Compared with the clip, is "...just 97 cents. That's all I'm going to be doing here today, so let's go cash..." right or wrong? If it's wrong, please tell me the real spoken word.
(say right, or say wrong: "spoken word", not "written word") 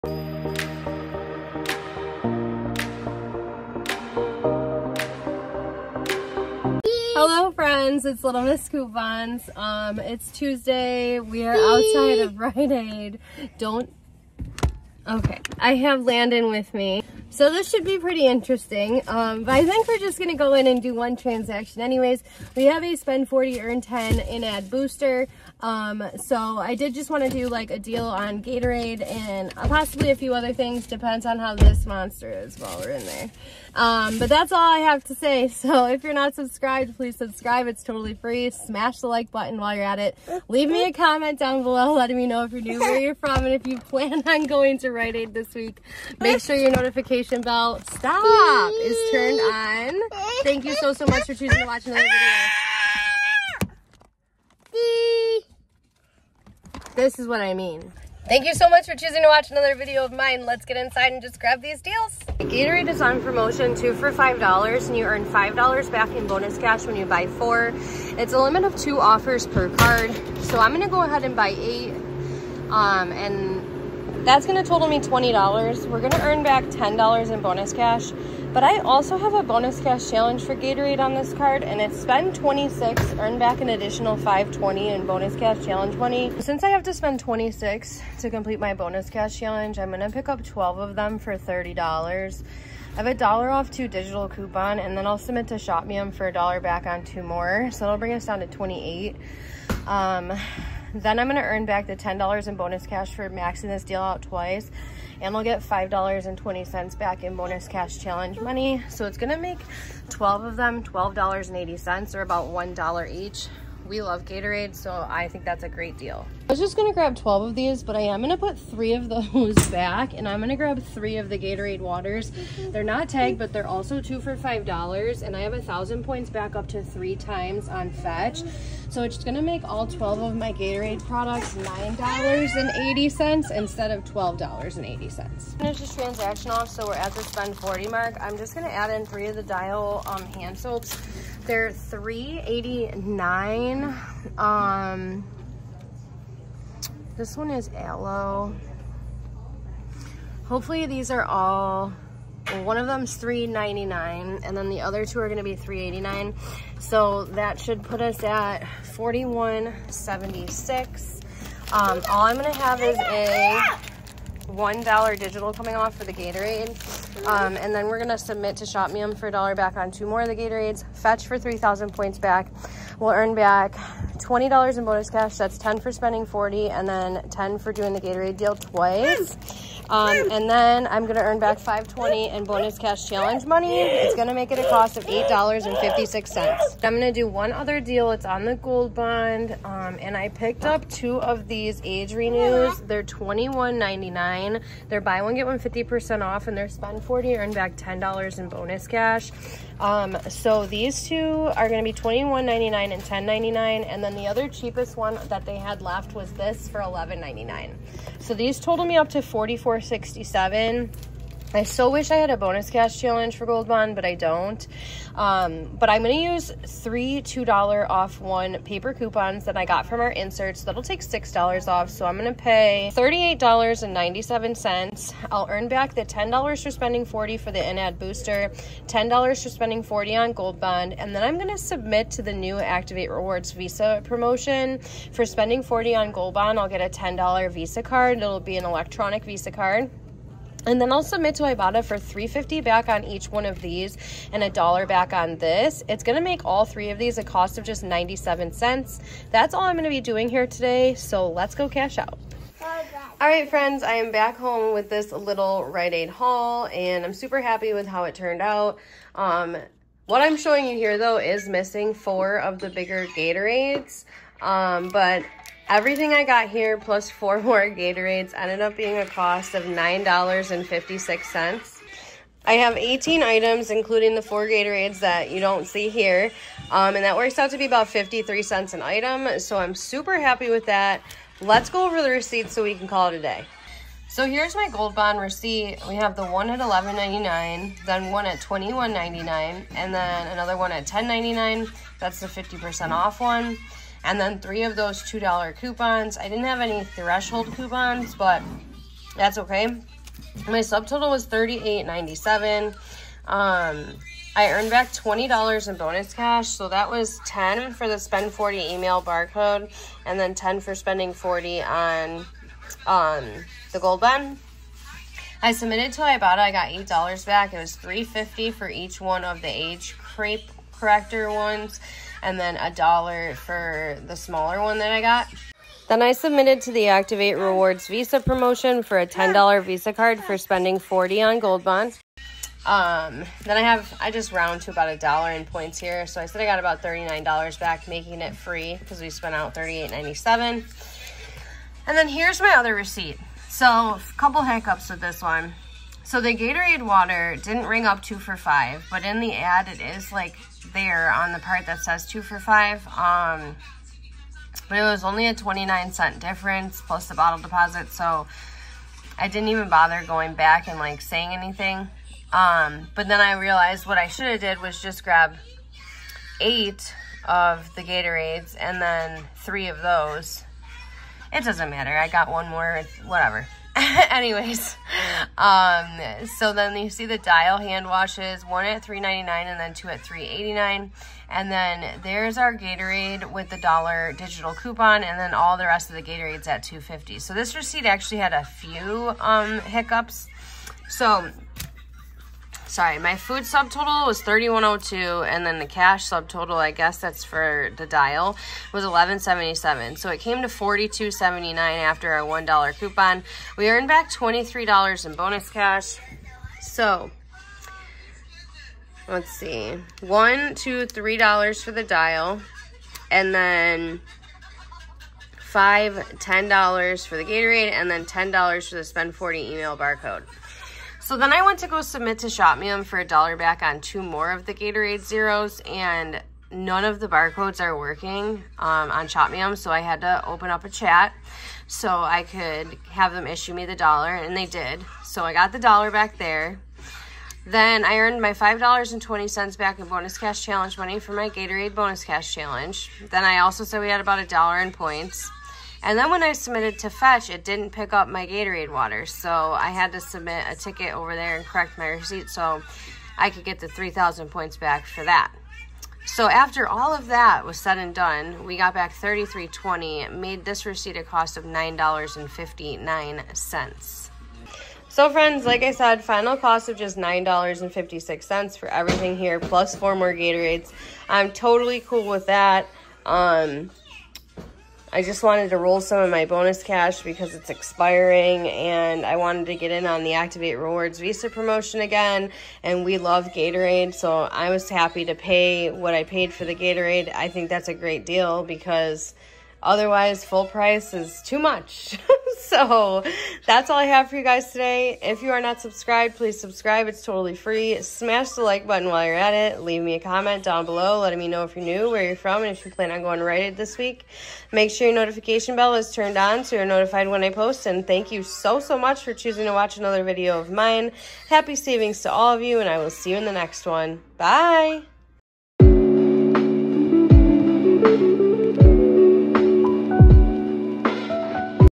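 right.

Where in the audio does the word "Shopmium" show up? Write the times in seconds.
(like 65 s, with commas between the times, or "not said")
95 s, 168 s, 422 s, 429 s.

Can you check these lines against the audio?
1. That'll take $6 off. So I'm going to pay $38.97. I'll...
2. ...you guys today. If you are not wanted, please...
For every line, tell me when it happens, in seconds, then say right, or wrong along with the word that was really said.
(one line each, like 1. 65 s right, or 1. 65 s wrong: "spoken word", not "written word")
1. 220 s right
2. 494 s wrong: "subscribed", not "wanted".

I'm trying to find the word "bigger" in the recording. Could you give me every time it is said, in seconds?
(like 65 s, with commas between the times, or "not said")
262 s.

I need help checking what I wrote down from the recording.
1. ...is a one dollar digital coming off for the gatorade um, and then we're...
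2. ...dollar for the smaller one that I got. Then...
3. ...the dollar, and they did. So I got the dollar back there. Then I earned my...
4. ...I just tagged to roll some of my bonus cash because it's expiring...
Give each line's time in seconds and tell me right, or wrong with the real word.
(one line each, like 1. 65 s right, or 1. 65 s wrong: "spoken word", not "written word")
1. 162 s right
2. 322 s right
3. 433 s right
4. 474 s wrong: "wanted", not "tagged".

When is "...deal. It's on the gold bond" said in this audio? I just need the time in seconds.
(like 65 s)
187 s.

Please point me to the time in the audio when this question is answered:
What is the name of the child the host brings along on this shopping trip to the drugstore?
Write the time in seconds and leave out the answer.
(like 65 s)
16 s.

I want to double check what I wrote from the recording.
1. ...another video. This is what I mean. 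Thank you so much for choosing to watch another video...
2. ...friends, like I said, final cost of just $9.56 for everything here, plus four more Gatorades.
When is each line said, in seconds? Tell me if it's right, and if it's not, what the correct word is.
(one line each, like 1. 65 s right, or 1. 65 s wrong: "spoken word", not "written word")
1. 51 s right
2. 465 s right.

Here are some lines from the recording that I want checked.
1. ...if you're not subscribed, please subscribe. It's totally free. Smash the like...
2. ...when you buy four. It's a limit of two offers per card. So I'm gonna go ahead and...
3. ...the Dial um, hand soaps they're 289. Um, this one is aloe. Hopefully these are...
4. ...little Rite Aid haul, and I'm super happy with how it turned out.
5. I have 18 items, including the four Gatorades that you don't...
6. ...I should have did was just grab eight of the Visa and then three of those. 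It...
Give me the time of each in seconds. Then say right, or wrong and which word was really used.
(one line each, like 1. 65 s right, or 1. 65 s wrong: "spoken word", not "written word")
1. 35 s right
2. 66 s right
3. 139 s wrong: "389", not "289"
4. 255 s right
5. 272 s right
6. 363 s wrong: "Gatorades", not "Visa".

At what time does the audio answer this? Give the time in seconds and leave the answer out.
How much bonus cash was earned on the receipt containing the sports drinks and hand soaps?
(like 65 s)
404 s.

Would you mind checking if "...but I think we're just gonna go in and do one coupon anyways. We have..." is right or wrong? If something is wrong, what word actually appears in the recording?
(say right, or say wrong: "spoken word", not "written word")
wrong: "transaction", not "coupon".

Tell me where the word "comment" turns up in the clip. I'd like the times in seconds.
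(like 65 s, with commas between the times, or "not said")
40 s, 499 s.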